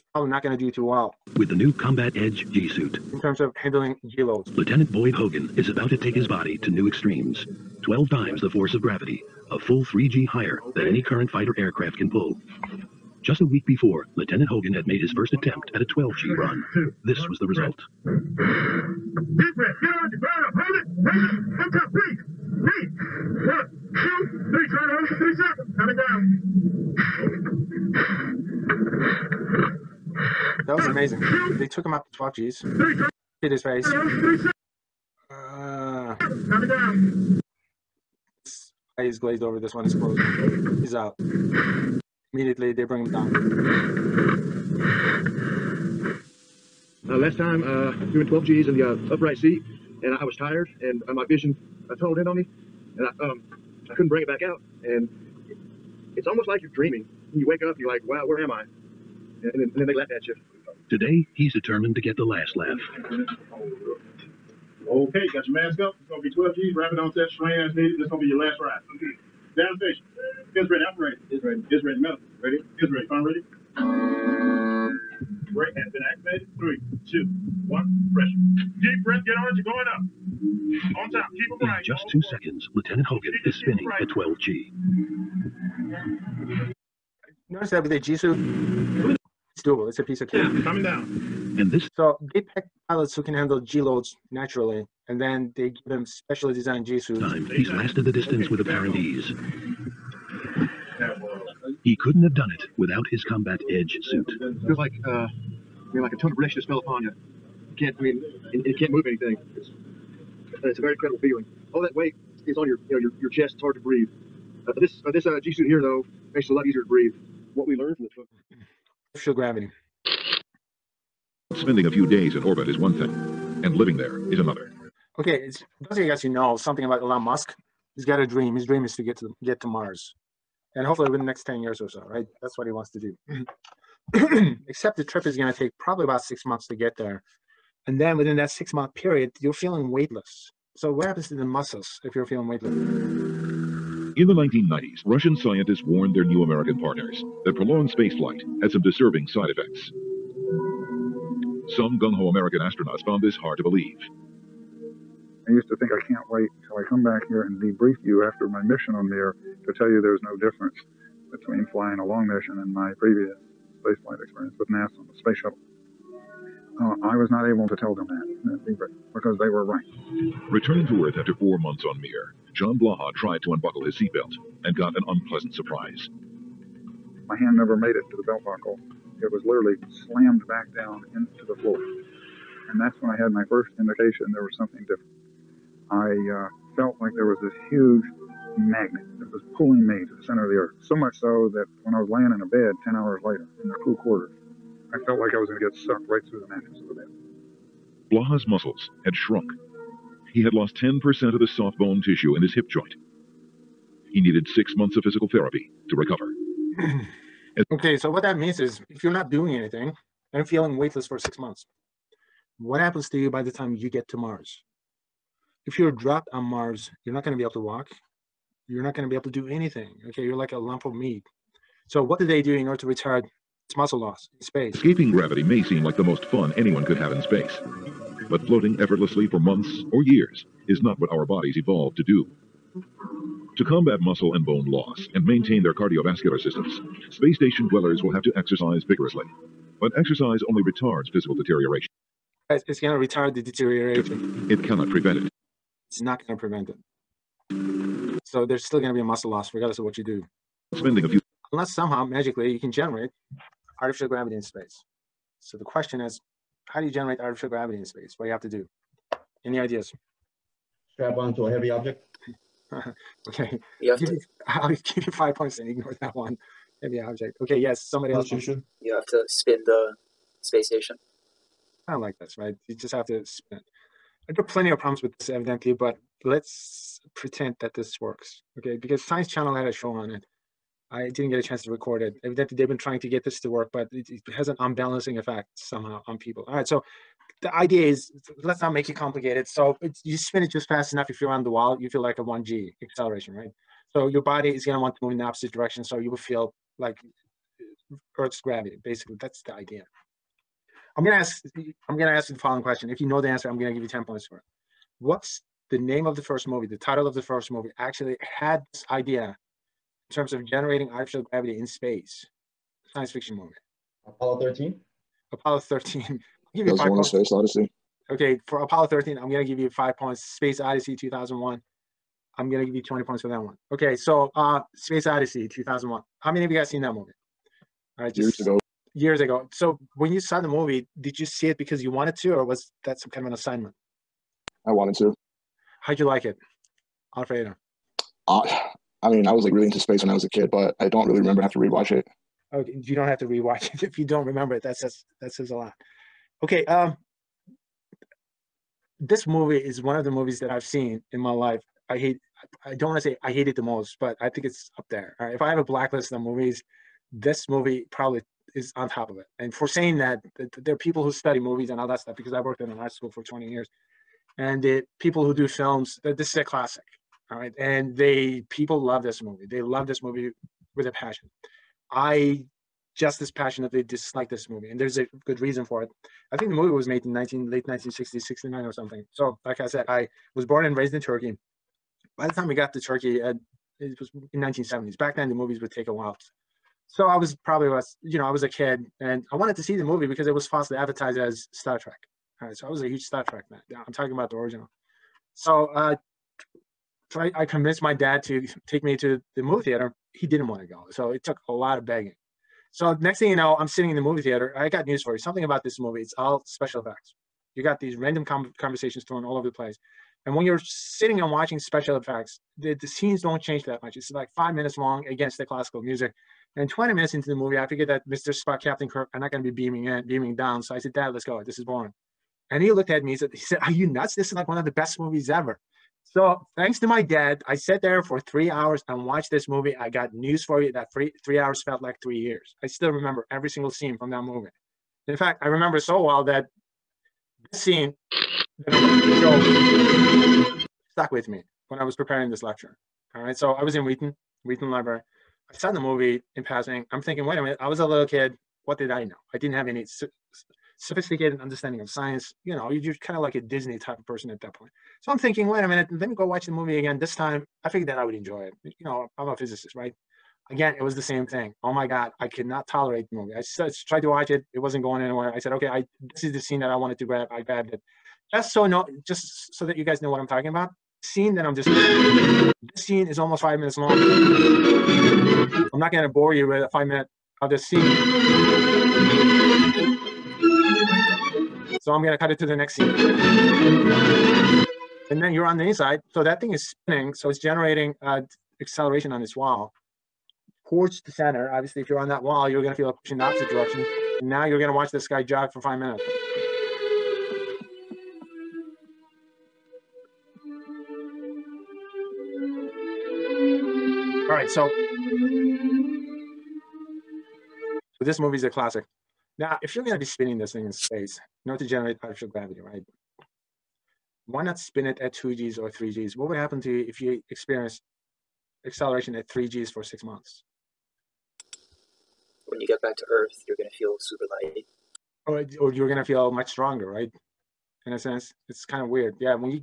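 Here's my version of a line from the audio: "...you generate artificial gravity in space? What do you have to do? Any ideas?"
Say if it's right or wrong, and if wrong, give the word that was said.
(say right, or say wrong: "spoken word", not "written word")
right.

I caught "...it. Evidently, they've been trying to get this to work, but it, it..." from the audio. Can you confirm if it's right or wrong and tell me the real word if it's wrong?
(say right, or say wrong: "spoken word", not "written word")
right.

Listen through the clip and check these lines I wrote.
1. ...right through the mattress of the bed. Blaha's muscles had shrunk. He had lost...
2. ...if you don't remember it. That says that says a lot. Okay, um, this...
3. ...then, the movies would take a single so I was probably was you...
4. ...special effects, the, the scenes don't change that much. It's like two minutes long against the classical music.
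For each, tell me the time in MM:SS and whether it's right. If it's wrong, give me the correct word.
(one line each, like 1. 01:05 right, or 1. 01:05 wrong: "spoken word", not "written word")
1. 03:16 right
2. 05:43 right
3. 06:25 wrong: "while", not "single"
4. 06:51 wrong: "five", not "two".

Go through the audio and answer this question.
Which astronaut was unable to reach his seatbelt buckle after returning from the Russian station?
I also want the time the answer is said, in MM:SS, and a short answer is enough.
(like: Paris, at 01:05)
John Blaha, at 02:52.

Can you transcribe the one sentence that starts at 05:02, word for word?
If you know the answer, I'm gonna give you ten points for it.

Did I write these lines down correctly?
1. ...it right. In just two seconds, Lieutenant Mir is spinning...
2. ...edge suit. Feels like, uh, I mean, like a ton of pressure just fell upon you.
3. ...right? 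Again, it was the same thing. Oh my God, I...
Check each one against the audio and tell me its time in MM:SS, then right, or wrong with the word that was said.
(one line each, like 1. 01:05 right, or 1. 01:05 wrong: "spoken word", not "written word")
1. 01:21 wrong: "Hogan", not "Mir"
2. 01:43 right
3. 07:39 right.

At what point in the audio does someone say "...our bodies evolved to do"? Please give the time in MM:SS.
03:51.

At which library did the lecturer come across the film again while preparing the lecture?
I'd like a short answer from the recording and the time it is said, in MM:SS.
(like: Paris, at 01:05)
Wheaton Library, at 07:24.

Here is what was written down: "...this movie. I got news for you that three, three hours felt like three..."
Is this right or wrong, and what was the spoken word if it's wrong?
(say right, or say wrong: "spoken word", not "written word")
right.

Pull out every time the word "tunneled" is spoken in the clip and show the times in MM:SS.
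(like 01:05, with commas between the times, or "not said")
00:51.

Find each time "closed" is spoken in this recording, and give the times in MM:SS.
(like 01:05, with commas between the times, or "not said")
00:39.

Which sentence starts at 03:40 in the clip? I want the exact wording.
Okay, you're like a lump of meat.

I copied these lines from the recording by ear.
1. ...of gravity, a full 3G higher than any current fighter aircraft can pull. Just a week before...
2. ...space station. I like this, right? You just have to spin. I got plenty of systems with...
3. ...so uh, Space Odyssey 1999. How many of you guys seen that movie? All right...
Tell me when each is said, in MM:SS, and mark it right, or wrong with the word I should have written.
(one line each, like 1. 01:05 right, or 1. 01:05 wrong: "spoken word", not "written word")
1. 00:08 right
2. 04:30 wrong: "problems", not "systems"
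3. 05:23 wrong: "2001", not "1999".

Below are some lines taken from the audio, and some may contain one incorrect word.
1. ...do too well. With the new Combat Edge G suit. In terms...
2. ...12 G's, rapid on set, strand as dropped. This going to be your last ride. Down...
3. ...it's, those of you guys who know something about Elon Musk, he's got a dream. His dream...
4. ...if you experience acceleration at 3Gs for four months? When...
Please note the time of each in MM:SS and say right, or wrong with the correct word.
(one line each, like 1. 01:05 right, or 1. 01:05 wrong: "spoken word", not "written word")
1. 00:00 right
2. 01:06 wrong: "needed", not "dropped"
3. 02:05 right
4. 08:36 wrong: "six", not "four".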